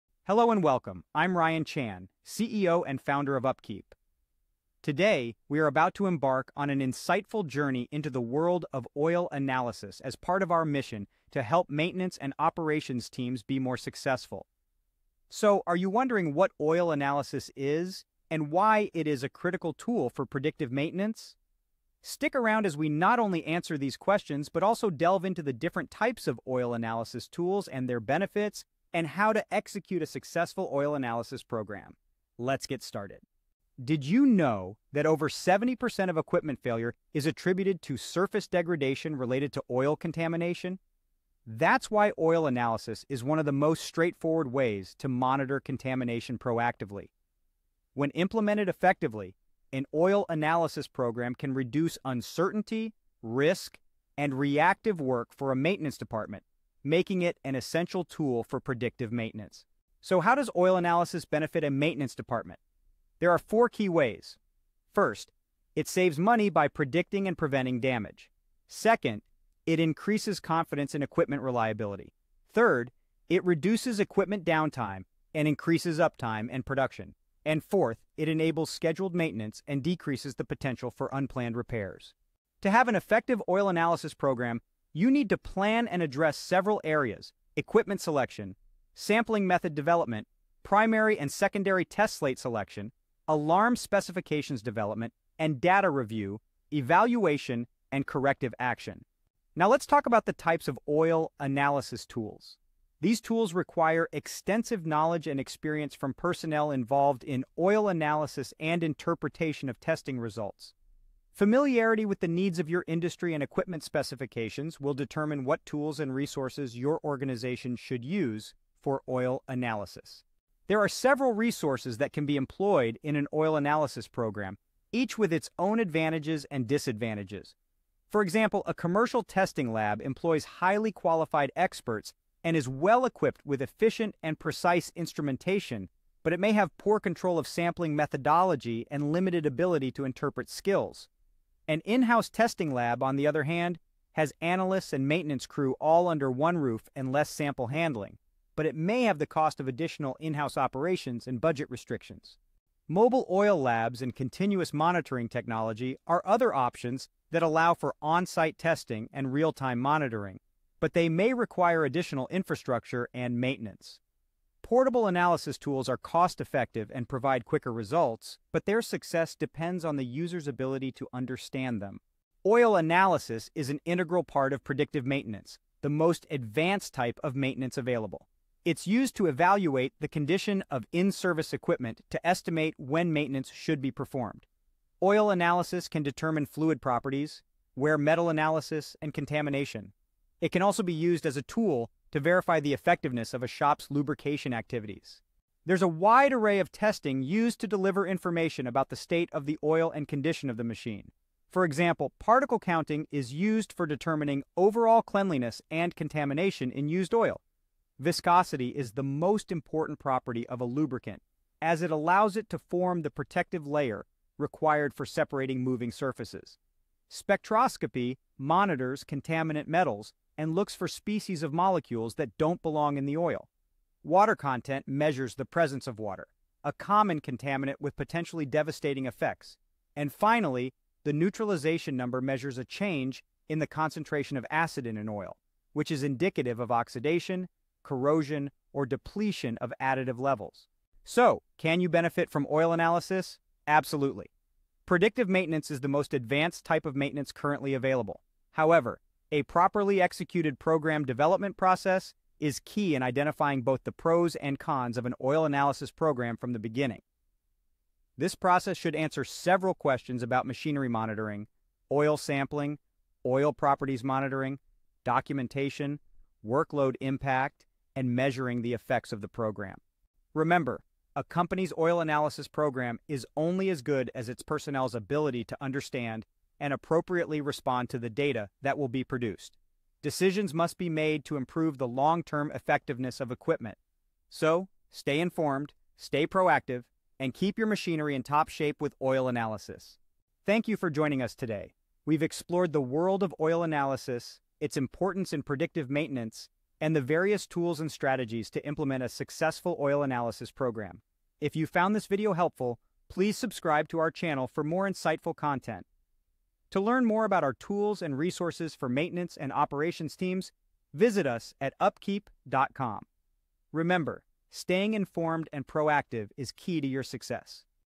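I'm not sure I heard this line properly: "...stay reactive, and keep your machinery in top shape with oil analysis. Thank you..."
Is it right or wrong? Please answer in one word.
wrong.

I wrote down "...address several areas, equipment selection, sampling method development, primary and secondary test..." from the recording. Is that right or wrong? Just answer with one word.
right.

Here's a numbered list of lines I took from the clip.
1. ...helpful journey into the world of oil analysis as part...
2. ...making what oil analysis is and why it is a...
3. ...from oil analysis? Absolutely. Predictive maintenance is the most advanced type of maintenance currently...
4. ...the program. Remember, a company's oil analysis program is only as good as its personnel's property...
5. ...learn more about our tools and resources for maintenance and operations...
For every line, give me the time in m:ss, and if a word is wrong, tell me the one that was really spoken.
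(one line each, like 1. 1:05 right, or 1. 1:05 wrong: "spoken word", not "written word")
1. 0:06 wrong: "insightful", not "helpful"
2. 0:15 wrong: "wondering", not "making"
3. 4:02 right
4. 4:29 wrong: "ability", not "property"
5. 5:06 right.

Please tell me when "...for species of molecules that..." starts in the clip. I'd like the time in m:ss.
3:40.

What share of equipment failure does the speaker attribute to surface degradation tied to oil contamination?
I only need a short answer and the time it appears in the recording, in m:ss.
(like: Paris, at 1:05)
over 70%, at 0:35.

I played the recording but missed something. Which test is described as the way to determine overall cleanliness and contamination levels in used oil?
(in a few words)
Particle counting.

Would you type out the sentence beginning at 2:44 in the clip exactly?
Portable analysis tools are cost-effective and provide quicker results, but their success depends on the user's ability to understand them.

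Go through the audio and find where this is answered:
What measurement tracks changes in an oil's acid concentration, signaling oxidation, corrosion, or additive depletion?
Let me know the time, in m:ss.
3:51.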